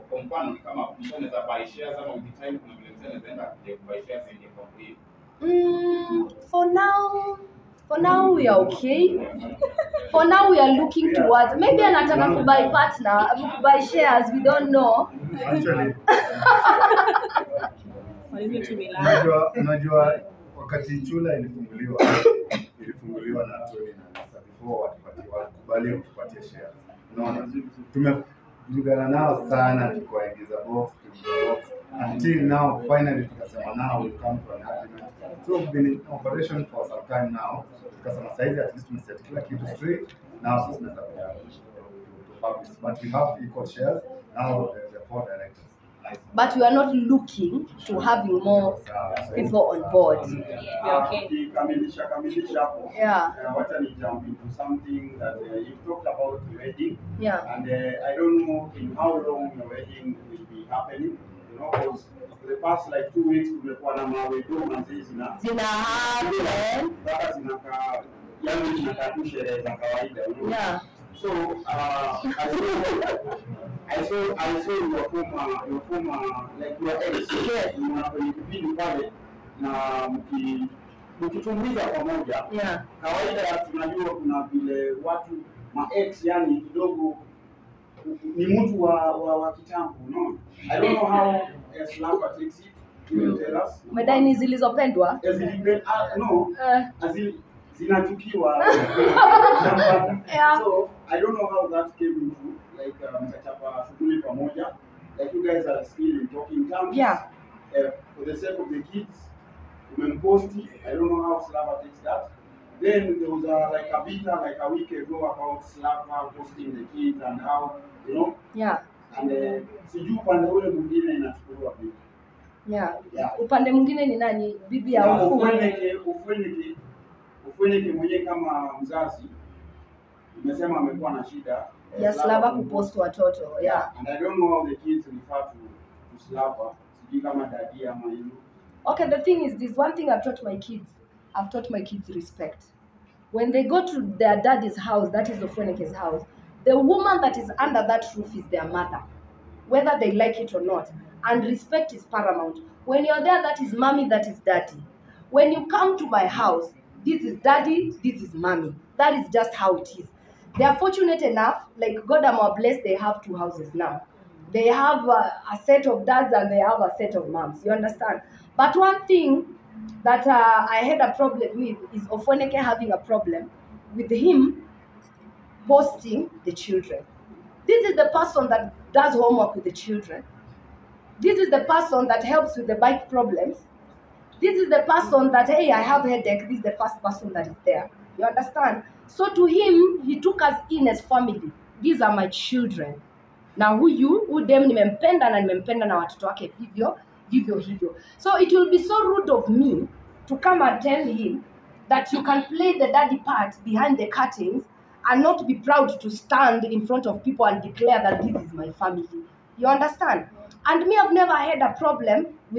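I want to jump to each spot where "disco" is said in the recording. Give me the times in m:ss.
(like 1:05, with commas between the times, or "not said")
not said.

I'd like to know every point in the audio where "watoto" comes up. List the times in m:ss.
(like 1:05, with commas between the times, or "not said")
2:12, 3:15.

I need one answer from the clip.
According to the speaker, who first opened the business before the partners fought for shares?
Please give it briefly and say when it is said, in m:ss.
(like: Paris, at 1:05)
Tony, at 0:23.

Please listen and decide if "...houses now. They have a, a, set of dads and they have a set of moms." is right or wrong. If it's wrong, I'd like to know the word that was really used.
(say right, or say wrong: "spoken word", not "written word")
right.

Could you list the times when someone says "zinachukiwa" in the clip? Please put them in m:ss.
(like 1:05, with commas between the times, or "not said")
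1:37.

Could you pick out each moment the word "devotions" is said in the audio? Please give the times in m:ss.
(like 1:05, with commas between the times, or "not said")
not said.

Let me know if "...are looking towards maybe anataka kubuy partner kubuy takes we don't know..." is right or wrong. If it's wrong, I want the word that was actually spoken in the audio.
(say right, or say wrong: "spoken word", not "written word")
wrong: "shares", not "takes".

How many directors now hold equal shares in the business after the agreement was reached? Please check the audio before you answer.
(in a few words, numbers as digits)
4.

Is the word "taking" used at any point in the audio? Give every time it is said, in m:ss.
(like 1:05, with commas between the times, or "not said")
not said.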